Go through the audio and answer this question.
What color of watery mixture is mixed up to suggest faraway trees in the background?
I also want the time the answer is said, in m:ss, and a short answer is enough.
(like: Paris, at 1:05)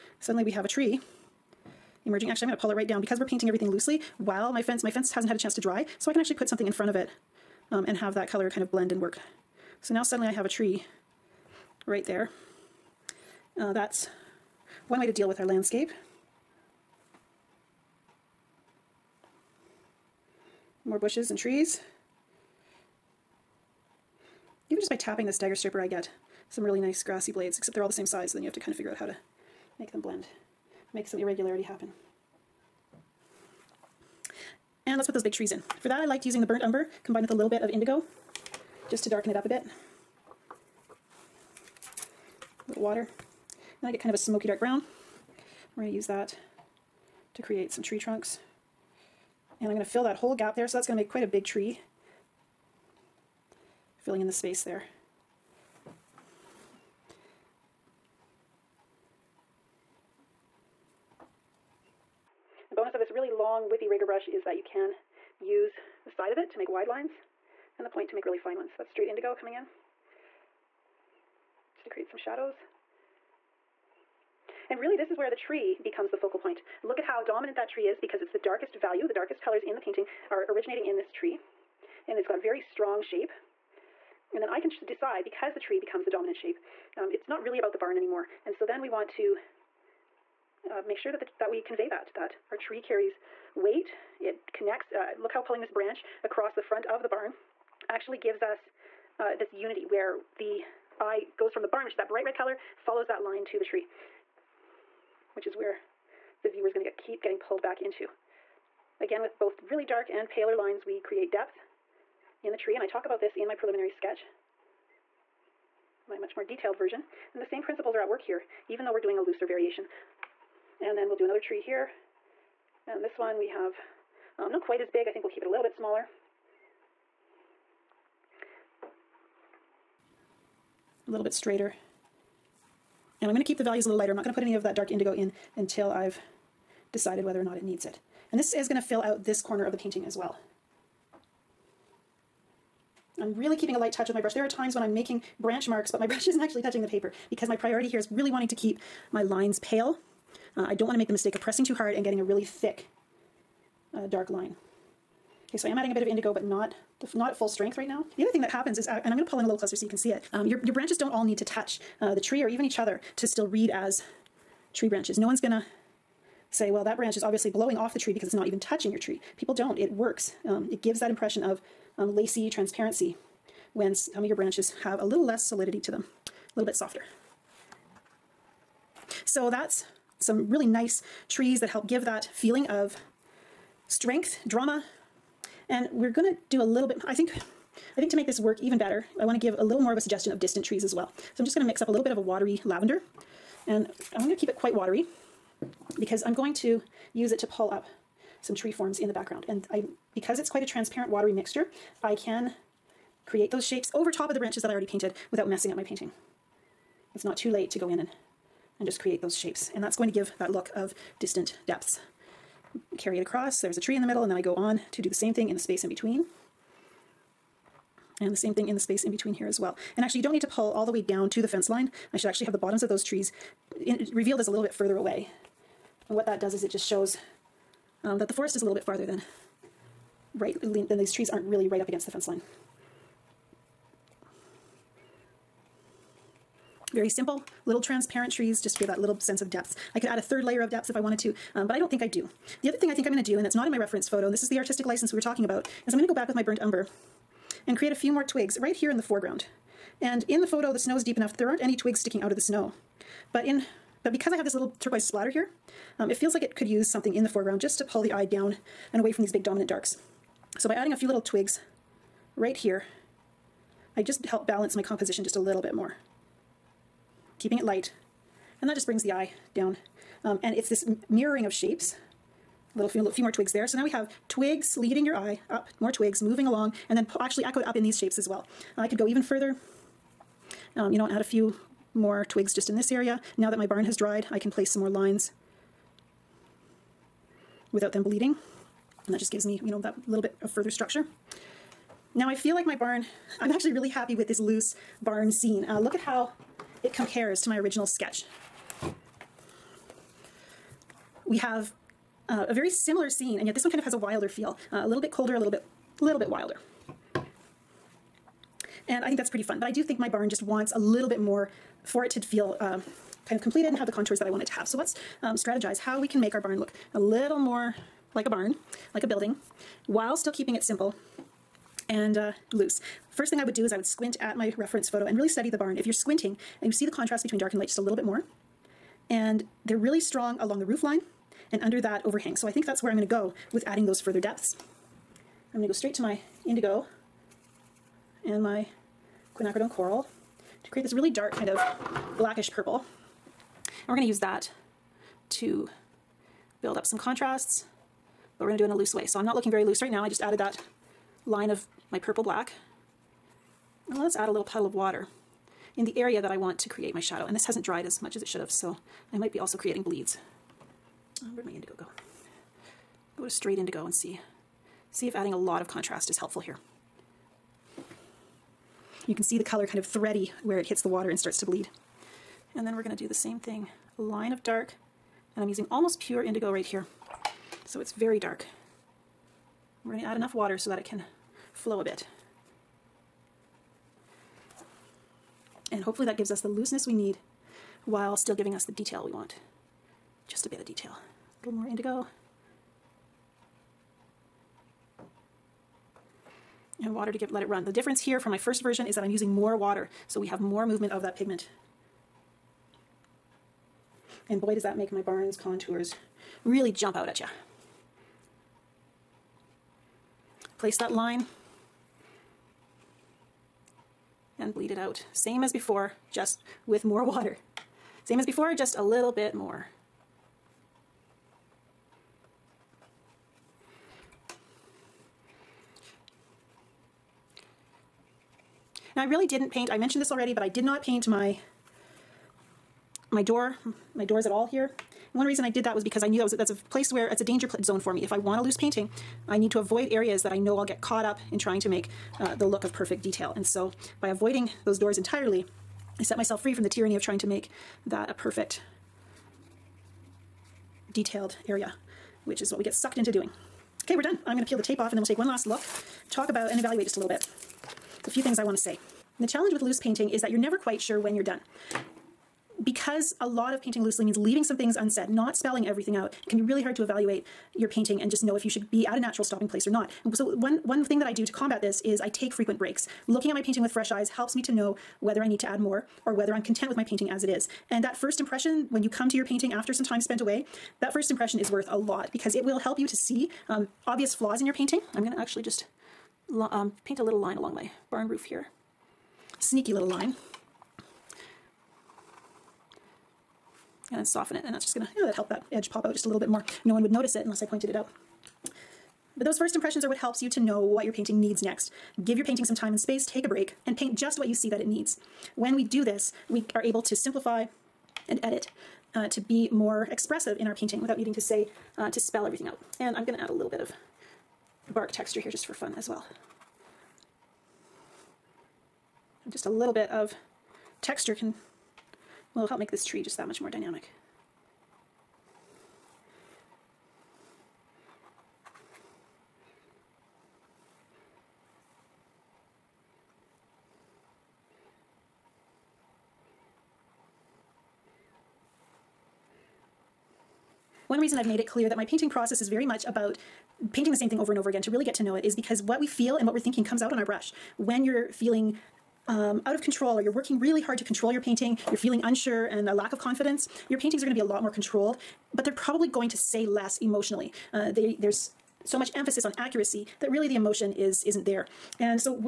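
lavender, at 3:12.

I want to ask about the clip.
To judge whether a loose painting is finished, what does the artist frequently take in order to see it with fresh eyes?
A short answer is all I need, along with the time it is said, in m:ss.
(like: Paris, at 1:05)
breaks, at 7:52.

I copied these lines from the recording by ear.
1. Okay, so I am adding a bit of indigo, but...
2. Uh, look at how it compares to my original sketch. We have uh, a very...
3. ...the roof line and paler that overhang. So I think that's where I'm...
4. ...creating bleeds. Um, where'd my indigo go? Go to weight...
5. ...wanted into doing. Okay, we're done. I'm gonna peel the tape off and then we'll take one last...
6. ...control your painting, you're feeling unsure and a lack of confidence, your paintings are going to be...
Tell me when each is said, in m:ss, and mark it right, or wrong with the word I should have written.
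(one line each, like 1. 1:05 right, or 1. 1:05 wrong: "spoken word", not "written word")
1. 2:35 right
2. 4:55 right
3. 5:30 wrong: "under", not "paler"
4. 5:59 wrong: "straight", not "weight"
5. 7:32 wrong: "sucked", not "wanted"
6. 9:10 right.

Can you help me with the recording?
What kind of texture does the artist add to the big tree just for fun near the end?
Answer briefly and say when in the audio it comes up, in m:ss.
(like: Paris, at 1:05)
bark texture, at 8:34.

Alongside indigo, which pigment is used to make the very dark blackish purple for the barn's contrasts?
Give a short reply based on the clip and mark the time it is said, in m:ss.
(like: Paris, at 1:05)
quinacridone coral, at 5:39.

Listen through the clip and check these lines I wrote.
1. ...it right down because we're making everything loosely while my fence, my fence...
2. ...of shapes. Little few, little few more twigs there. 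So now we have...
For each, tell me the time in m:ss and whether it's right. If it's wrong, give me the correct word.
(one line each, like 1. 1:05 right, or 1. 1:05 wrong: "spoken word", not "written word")
1. 0:02 wrong: "painting", not "making"
2. 4:31 right.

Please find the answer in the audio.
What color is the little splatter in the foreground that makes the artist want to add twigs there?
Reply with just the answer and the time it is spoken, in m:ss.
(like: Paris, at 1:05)
turquoise, at 4:14.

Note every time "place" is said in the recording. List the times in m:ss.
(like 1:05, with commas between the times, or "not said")
4:44, 6:50, 7:16, 7:49.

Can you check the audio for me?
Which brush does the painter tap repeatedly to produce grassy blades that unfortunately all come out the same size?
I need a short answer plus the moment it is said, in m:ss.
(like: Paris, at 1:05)
dagger striper, at 0:25.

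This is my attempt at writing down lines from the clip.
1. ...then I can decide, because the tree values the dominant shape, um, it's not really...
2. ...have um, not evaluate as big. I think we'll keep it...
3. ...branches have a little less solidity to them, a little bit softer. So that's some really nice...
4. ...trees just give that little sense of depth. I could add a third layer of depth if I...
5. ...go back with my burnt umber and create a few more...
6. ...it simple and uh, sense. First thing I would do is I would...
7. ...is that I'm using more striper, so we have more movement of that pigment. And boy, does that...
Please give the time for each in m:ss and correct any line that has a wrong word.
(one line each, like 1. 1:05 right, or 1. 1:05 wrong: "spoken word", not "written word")
1. 1:24 wrong: "becomes", not "values"
2. 2:03 wrong: "quite", not "evaluate"
3. 2:54 right
4. 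3:58 right
5. 4:06 right
6. 5:20 wrong: "loose", not "sense"
7. 6:38 wrong: "water", not "striper".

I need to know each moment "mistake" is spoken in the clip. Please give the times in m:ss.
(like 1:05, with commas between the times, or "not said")
2:31.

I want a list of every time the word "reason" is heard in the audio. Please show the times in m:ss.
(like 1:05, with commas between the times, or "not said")
7:15, 9:01.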